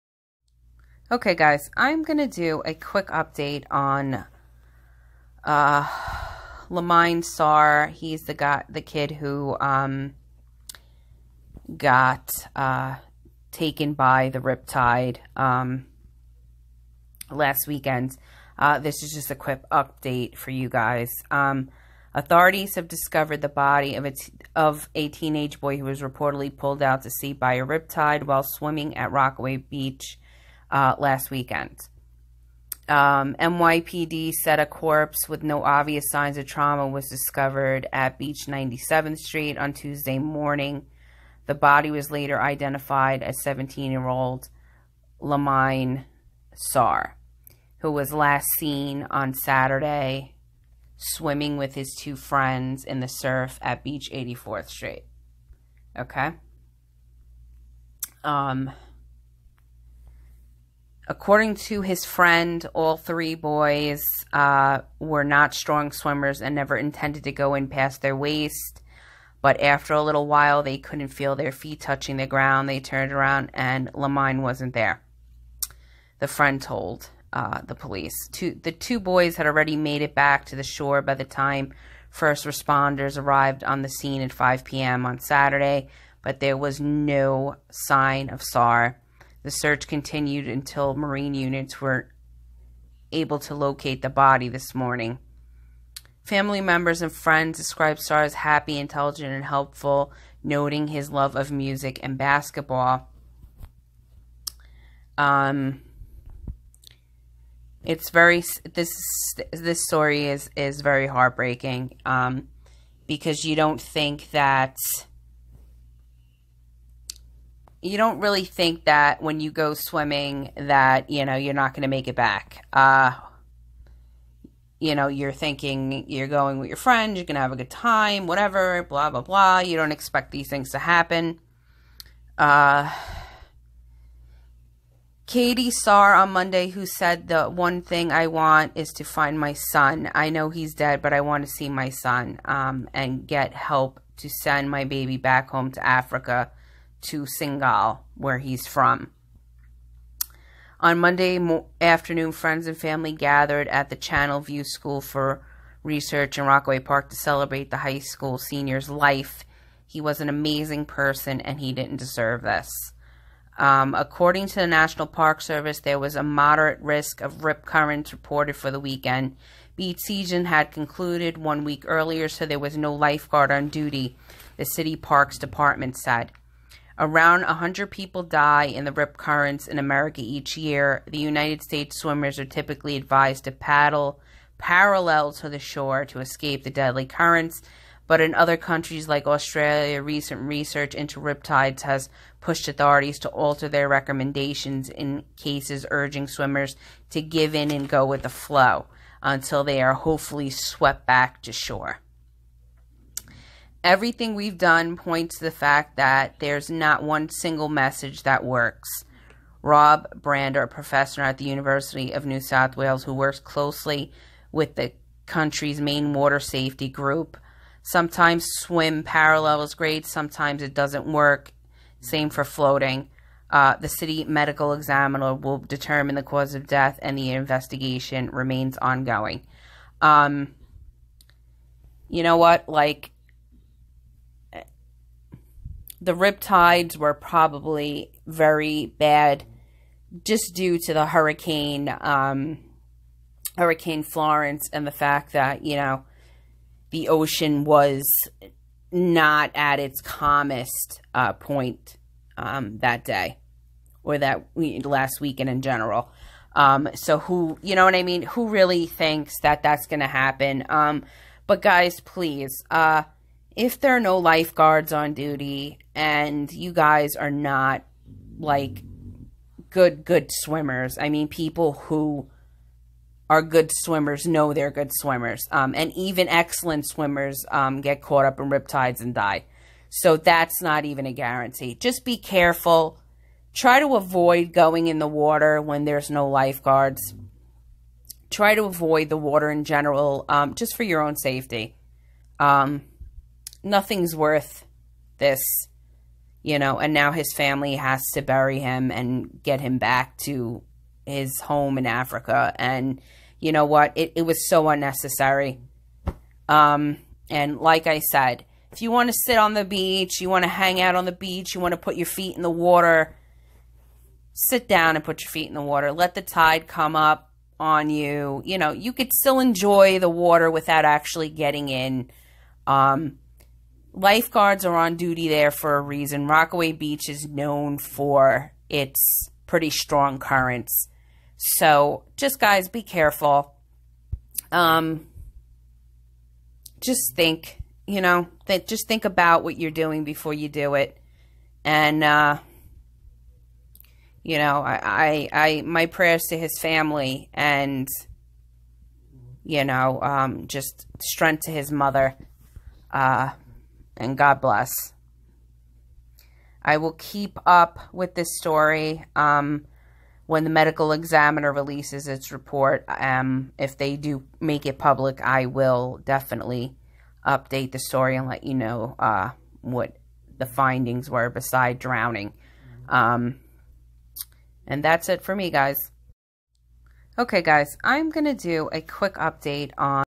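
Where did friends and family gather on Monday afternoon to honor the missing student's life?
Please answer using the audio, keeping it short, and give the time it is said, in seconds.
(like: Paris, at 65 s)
Channel View School for Research, at 153 s.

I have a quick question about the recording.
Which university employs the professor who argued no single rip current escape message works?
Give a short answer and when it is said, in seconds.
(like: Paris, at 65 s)
University of New South Wales, at 211 s.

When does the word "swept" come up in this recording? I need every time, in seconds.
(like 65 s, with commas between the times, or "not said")
200 s.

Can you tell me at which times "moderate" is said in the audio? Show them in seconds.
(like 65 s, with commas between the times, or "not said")
166 s.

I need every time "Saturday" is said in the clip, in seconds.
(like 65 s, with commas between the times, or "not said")
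49 s, 85 s.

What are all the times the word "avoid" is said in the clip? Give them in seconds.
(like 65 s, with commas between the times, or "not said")
283 s, 288 s.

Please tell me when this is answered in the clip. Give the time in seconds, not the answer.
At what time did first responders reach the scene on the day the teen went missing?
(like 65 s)
84 s.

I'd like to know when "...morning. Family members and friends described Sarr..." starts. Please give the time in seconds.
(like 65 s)
94 s.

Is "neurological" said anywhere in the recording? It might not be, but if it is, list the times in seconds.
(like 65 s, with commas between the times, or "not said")
not said.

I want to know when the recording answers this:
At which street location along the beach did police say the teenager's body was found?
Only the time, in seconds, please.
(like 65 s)
38 s.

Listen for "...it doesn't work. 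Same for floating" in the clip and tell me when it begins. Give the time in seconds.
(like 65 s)
220 s.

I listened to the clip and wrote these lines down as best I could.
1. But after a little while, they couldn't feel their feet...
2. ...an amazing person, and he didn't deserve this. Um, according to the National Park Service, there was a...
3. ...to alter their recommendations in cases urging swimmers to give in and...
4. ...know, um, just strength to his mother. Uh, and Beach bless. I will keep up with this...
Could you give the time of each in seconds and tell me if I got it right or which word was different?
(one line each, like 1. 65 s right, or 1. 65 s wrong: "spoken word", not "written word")
1. 69 s right
2. 160 s right
3. 193 s right
4. 349 s wrong: "God", not "Beach".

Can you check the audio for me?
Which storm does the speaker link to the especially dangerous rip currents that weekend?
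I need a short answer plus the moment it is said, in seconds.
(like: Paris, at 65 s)
Hurricane Florence, at 243 s.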